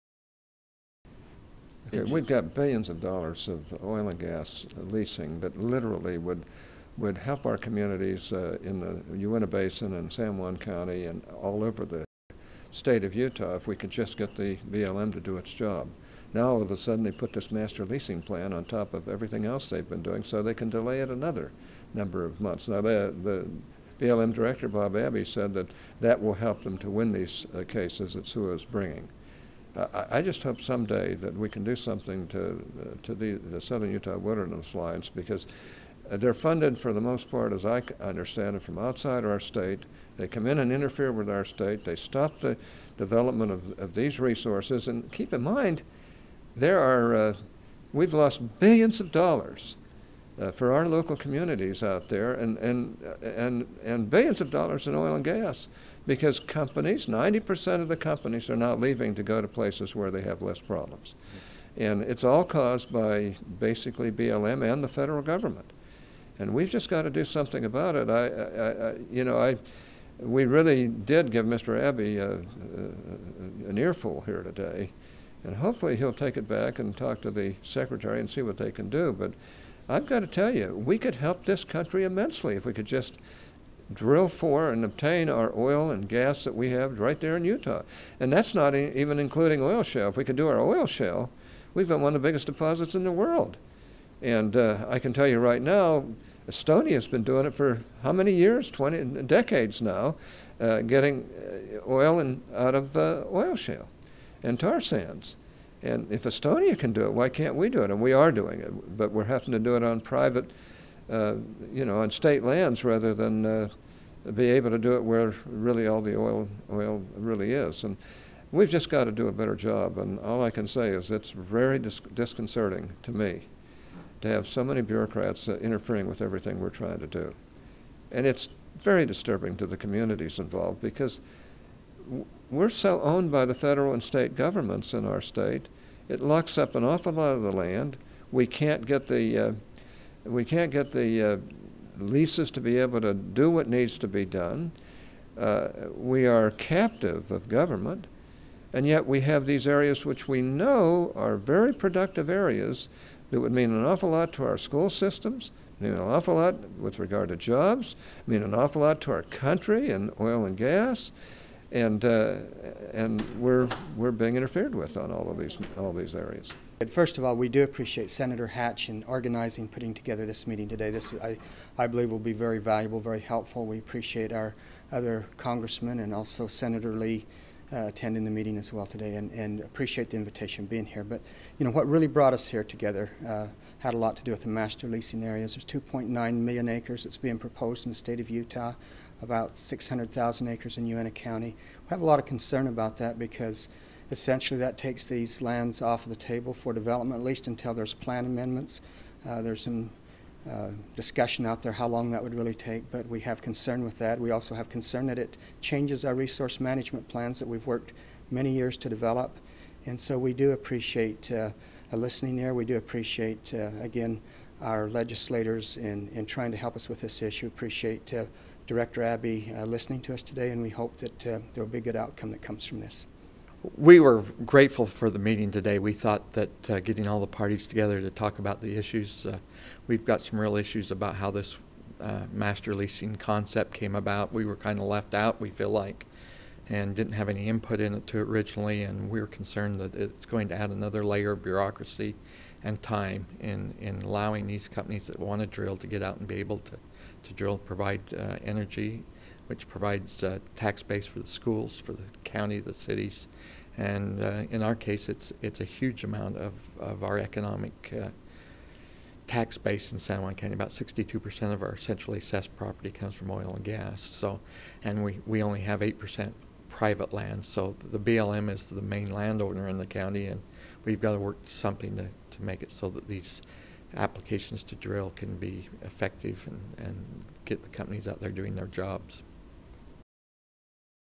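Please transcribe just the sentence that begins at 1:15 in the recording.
And hopefully he'll take it back and talk to the secretary and see what they can do.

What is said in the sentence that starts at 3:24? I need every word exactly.
We also have concern that it changes our resource management plans that we've worked many years to develop.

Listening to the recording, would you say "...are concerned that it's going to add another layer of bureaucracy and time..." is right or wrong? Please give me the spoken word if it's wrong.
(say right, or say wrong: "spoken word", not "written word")
right.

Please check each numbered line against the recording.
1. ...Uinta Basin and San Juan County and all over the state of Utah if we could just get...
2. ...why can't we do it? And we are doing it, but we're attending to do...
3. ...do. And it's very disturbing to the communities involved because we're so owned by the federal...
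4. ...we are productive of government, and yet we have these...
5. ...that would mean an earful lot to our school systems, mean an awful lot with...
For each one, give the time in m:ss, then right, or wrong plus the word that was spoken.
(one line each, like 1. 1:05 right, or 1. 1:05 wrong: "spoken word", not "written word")
1. 0:09 right
2. 1:47 wrong: "having", not "attending"
3. 2:07 right
4. 2:25 wrong: "captive", not "productive"
5. 2:33 wrong: "awful", not "earful".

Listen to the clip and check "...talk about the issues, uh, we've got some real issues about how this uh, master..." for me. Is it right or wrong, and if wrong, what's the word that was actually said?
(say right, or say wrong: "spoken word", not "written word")
right.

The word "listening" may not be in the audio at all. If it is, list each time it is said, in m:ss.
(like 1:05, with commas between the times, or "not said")
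3:31, 3:39.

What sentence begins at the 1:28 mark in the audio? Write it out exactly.
And that's not even including oil shale.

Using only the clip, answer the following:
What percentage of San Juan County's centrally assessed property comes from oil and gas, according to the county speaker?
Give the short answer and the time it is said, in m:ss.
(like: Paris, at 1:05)
62%, at 4:20.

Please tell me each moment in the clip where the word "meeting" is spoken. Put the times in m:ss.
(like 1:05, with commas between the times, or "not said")
2:50, 2:58, 3:45.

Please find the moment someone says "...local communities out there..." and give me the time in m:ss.
0:50.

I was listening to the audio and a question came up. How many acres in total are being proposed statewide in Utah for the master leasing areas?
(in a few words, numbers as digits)
2.9 million acres.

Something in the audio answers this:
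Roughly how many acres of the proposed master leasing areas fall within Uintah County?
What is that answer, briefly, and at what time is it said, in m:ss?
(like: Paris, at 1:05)
600,000 acres, at 3:09.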